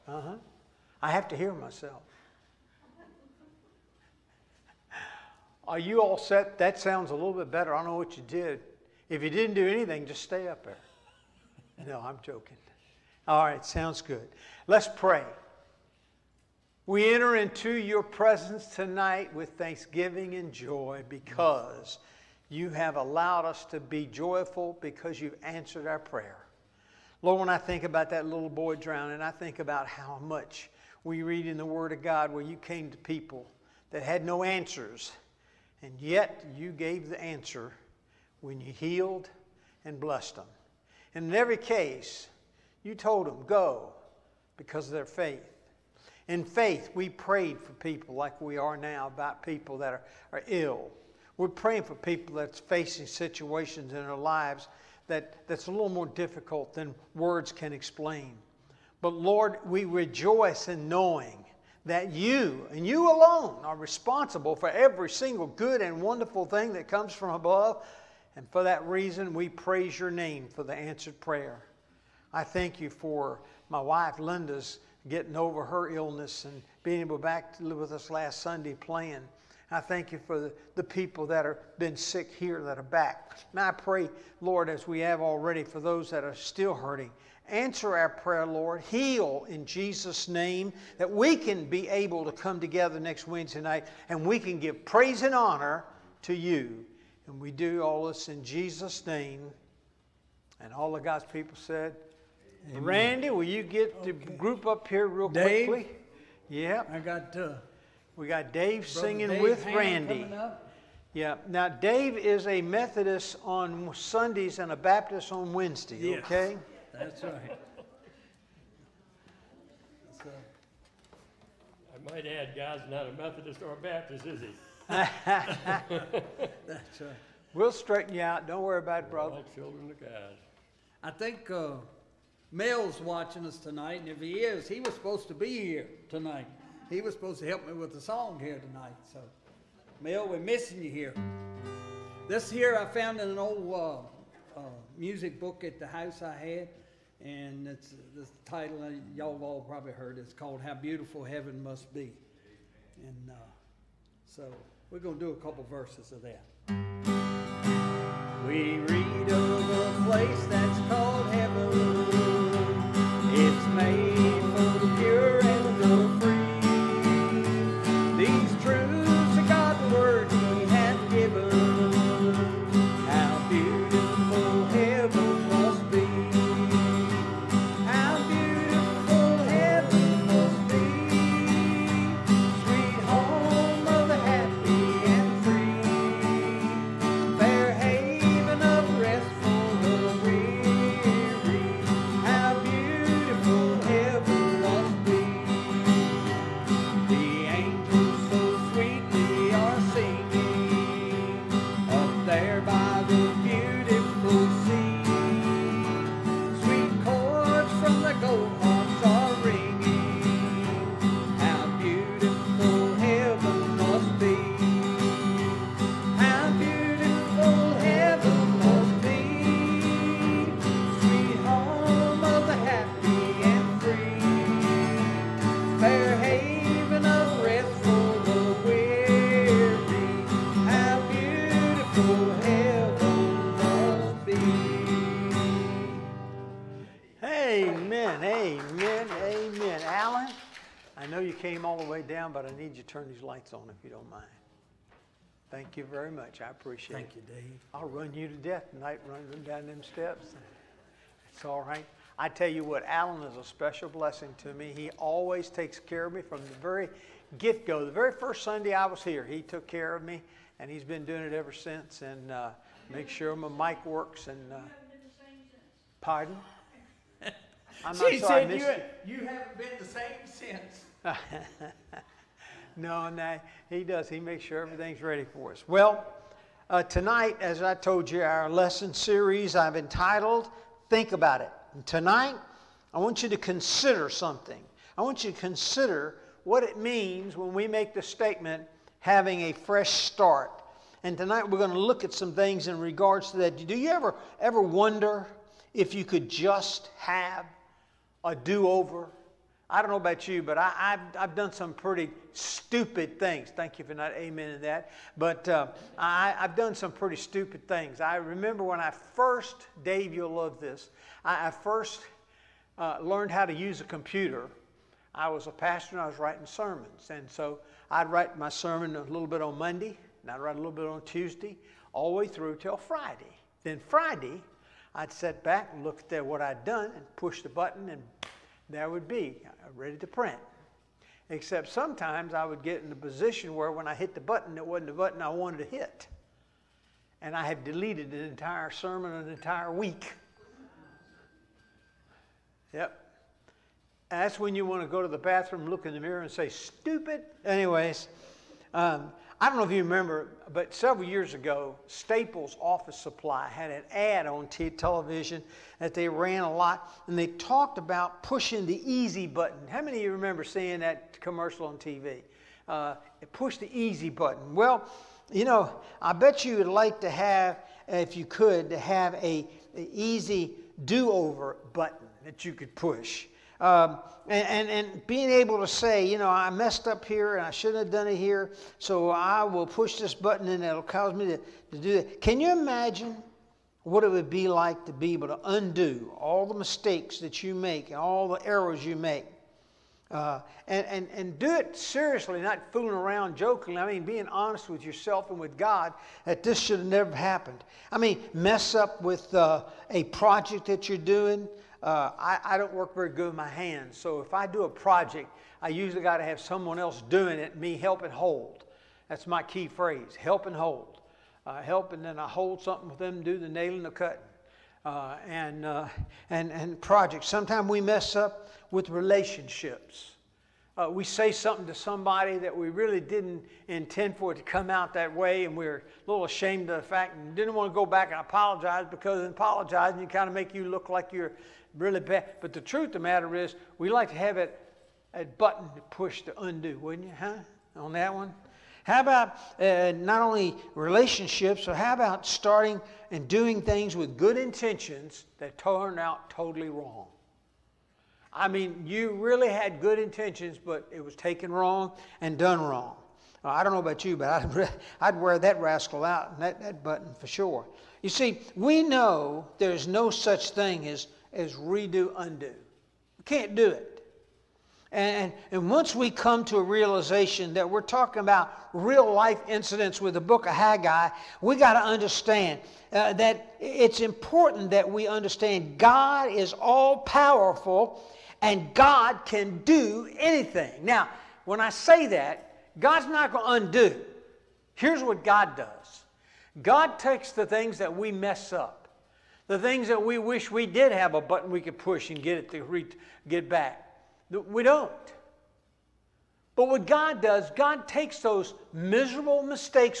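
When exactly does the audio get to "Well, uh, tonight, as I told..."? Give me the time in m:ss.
4:35.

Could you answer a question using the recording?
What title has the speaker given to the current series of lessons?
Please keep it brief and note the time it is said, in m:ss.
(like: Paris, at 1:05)
Think About It, at 4:40.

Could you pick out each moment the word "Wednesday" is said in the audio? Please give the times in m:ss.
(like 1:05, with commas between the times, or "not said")
1:33, 1:55.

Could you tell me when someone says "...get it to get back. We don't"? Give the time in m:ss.
8:12.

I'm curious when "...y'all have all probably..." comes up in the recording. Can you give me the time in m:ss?
2:29.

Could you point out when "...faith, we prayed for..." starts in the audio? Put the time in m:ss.
0:46.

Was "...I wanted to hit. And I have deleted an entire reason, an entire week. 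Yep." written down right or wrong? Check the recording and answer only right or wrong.
wrong.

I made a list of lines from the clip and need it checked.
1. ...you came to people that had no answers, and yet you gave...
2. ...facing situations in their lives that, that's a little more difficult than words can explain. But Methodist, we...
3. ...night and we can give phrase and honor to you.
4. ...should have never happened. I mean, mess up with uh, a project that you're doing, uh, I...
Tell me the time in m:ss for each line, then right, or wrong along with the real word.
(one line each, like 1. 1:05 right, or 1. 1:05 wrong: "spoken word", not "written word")
1. 0:32 right
2. 0:52 wrong: "Lord", not "Methodist"
3. 1:33 wrong: "praise", not "phrase"
4. 6:36 right.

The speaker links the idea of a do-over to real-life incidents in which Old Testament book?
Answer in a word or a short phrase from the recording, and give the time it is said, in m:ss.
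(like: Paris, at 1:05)
Haggai, at 7:50.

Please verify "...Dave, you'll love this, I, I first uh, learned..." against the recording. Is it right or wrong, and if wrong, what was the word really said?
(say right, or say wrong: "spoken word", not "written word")
right.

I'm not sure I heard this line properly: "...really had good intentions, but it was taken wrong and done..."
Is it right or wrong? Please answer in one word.
right.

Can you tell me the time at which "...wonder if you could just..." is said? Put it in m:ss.
4:54.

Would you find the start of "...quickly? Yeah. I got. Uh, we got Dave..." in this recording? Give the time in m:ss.
1:45.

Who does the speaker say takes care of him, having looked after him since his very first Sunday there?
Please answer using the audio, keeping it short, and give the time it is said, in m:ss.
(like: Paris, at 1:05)
Alan, at 4:12.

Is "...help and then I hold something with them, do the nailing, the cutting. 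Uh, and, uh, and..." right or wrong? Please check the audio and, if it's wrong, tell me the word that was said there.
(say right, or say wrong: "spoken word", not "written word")
right.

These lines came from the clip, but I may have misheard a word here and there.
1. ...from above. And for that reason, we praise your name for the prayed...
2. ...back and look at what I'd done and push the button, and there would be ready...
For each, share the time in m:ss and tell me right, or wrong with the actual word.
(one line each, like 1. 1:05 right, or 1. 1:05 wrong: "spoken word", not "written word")
1. 1:07 wrong: "answered", not "prayed"
2. 5:25 right.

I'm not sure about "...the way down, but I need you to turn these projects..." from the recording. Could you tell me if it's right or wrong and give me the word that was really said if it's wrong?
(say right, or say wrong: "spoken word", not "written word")
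wrong: "lights", not "projects".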